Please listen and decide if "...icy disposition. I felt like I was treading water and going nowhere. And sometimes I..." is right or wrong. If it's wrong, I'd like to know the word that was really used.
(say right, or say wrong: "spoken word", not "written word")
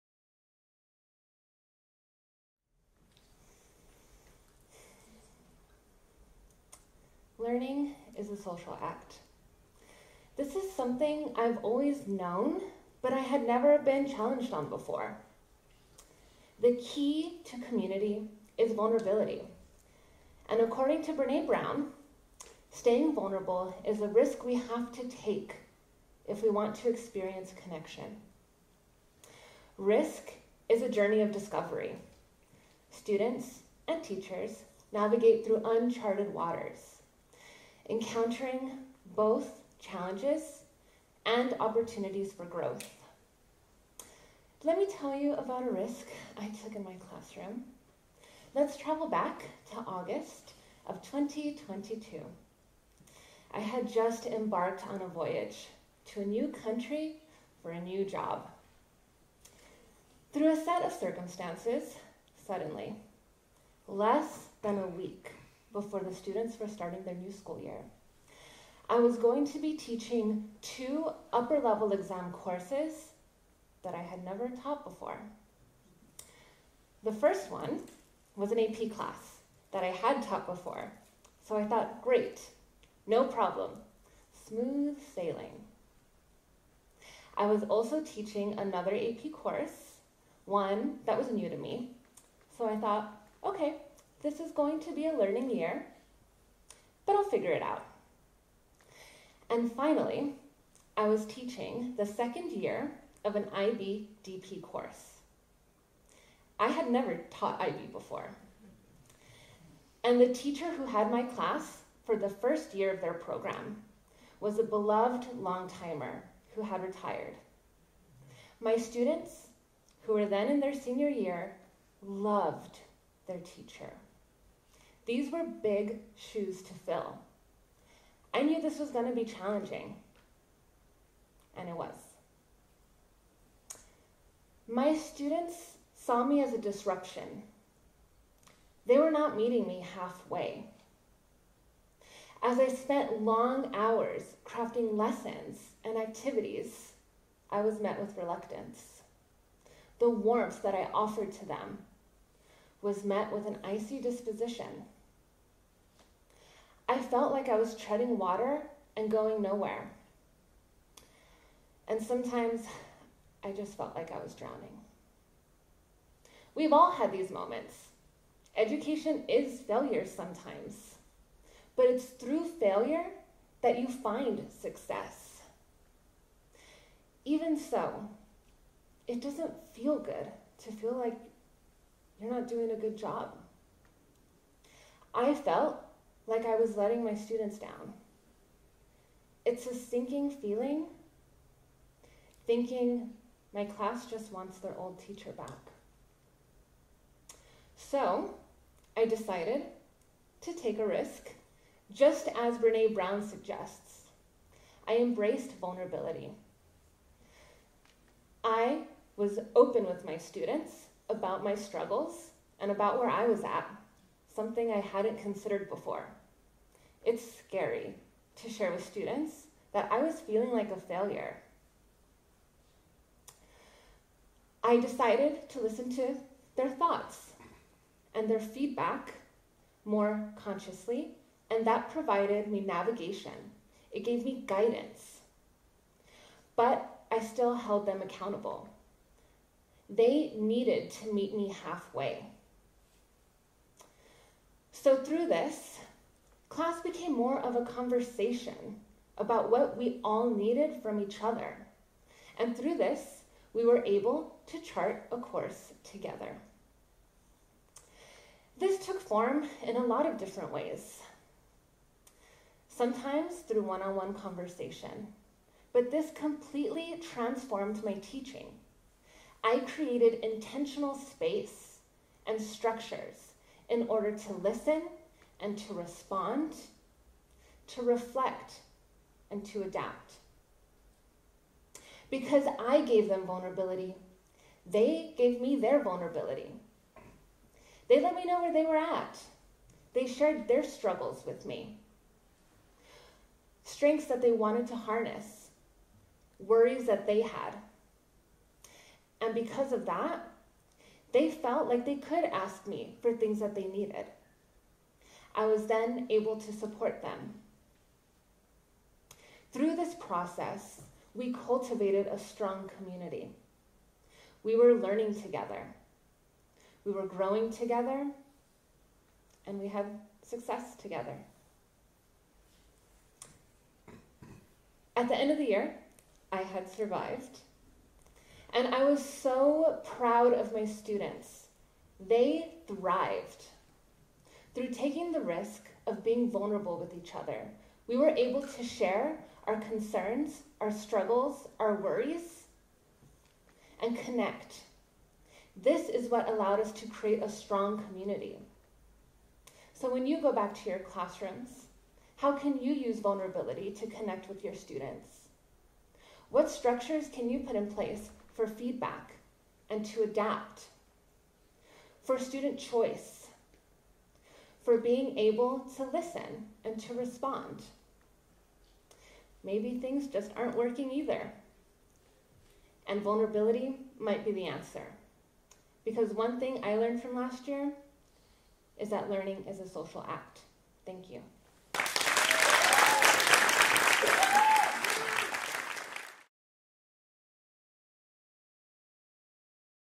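right.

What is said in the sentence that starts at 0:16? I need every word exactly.
The key to community is vulnerability.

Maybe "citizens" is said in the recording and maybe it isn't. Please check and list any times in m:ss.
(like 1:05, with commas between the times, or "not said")
not said.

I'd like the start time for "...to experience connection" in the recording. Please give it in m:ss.
0:26.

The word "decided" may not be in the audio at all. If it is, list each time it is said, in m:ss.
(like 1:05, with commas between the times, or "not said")
3:19, 3:44.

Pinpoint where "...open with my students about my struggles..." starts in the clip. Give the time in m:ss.
3:29.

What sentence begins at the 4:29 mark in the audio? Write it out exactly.
I created intentional space and structures in order to listen and to respond, to reflect and to adapt.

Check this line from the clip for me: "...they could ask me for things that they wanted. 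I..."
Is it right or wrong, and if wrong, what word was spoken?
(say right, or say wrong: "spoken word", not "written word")
wrong: "needed", not "wanted".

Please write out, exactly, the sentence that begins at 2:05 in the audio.
These were big shoes to fill.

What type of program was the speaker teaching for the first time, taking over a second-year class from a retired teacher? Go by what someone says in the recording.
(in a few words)
IB DP.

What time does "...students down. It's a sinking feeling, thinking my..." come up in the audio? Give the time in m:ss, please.
3:07.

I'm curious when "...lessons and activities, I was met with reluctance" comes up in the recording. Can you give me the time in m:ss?
2:24.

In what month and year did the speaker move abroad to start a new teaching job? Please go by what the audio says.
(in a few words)
August 2022.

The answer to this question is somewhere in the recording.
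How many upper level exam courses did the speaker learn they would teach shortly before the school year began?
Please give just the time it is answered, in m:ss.
1:10.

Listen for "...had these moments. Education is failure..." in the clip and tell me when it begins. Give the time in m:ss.
2:46.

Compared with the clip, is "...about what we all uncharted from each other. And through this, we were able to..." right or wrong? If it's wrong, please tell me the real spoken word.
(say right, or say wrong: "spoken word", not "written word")
wrong: "needed", not "uncharted".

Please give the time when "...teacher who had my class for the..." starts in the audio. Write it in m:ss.
1:50.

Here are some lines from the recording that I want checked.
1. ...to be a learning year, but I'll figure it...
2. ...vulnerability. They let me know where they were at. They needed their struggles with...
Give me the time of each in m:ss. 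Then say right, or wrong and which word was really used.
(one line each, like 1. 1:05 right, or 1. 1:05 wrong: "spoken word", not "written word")
1. 1:34 right
2. 4:45 wrong: "shared", not "needed".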